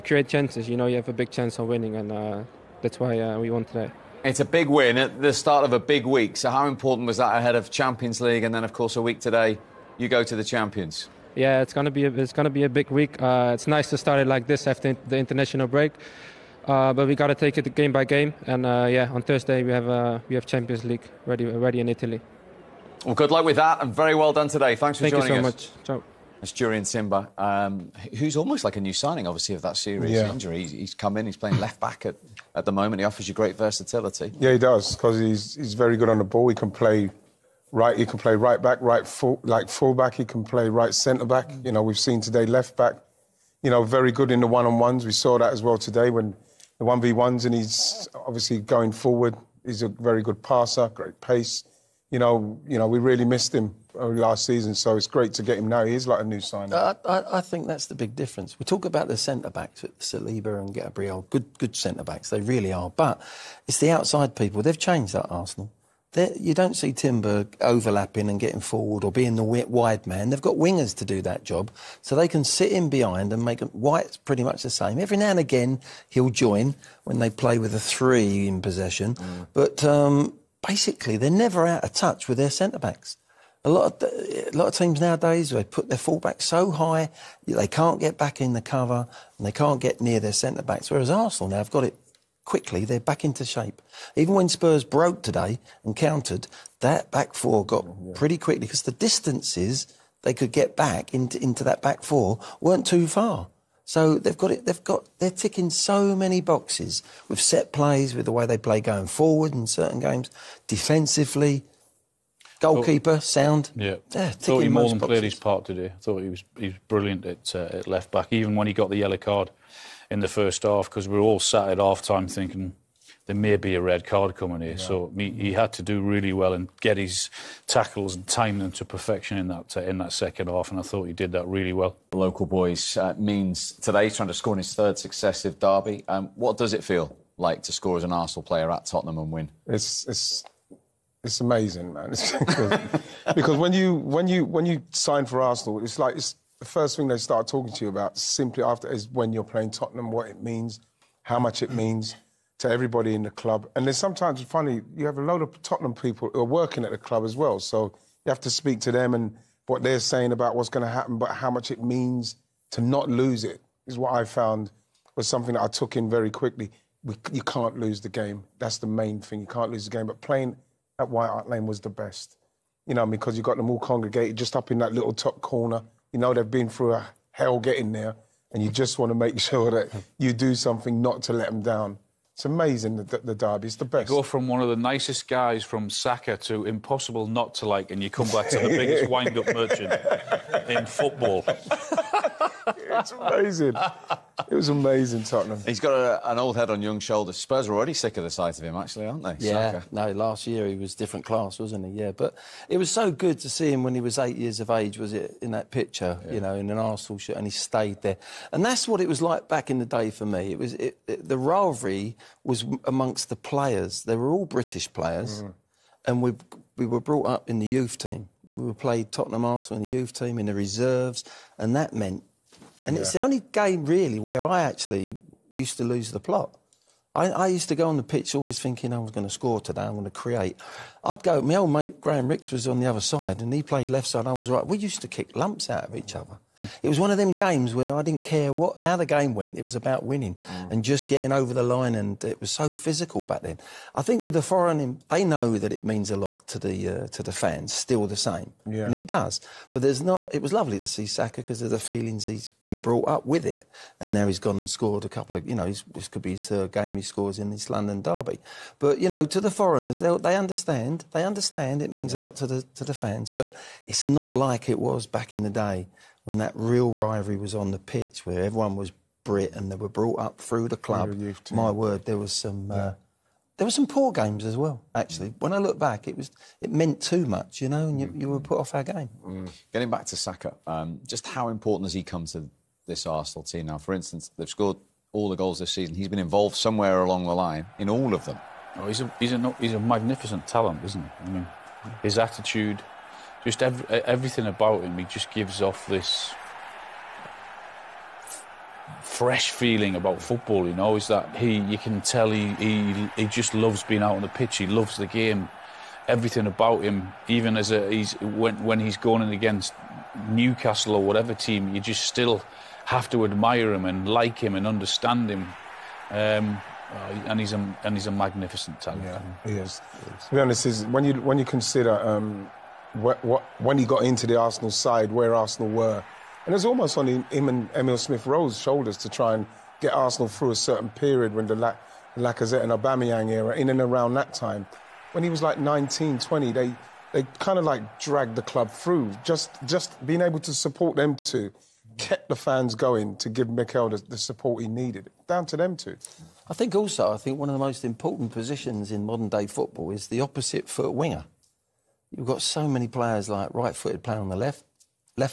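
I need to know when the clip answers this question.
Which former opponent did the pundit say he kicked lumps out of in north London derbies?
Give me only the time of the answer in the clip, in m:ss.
3:52.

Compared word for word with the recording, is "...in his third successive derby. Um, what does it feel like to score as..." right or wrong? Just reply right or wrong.
right.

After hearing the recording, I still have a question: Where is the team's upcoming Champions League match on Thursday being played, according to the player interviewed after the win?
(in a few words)
Italy.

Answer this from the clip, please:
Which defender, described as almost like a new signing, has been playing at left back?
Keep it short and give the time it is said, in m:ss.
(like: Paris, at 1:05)
Jurrien Timber, at 0:26.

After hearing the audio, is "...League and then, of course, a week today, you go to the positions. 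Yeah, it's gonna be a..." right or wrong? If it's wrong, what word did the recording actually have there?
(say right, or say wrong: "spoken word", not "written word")
wrong: "champions", not "positions".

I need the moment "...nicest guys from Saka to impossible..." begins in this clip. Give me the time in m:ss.
3:04.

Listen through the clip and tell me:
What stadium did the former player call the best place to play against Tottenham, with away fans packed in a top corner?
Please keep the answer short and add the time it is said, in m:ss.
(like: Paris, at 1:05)
White Hart Lane, at 2:51.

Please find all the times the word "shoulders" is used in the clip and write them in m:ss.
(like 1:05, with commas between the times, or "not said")
3:16, 5:28.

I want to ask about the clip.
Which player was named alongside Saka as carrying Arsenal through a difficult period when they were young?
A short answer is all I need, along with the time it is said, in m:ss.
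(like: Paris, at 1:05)
Emil Smith Rowe, at 5:27.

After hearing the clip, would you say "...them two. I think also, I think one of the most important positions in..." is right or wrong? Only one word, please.
right.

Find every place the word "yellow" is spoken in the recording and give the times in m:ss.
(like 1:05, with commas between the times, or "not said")
1:58.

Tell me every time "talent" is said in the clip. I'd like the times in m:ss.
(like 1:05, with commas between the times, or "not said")
4:50, 5:18.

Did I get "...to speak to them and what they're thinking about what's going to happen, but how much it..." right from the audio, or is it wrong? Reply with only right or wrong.
wrong.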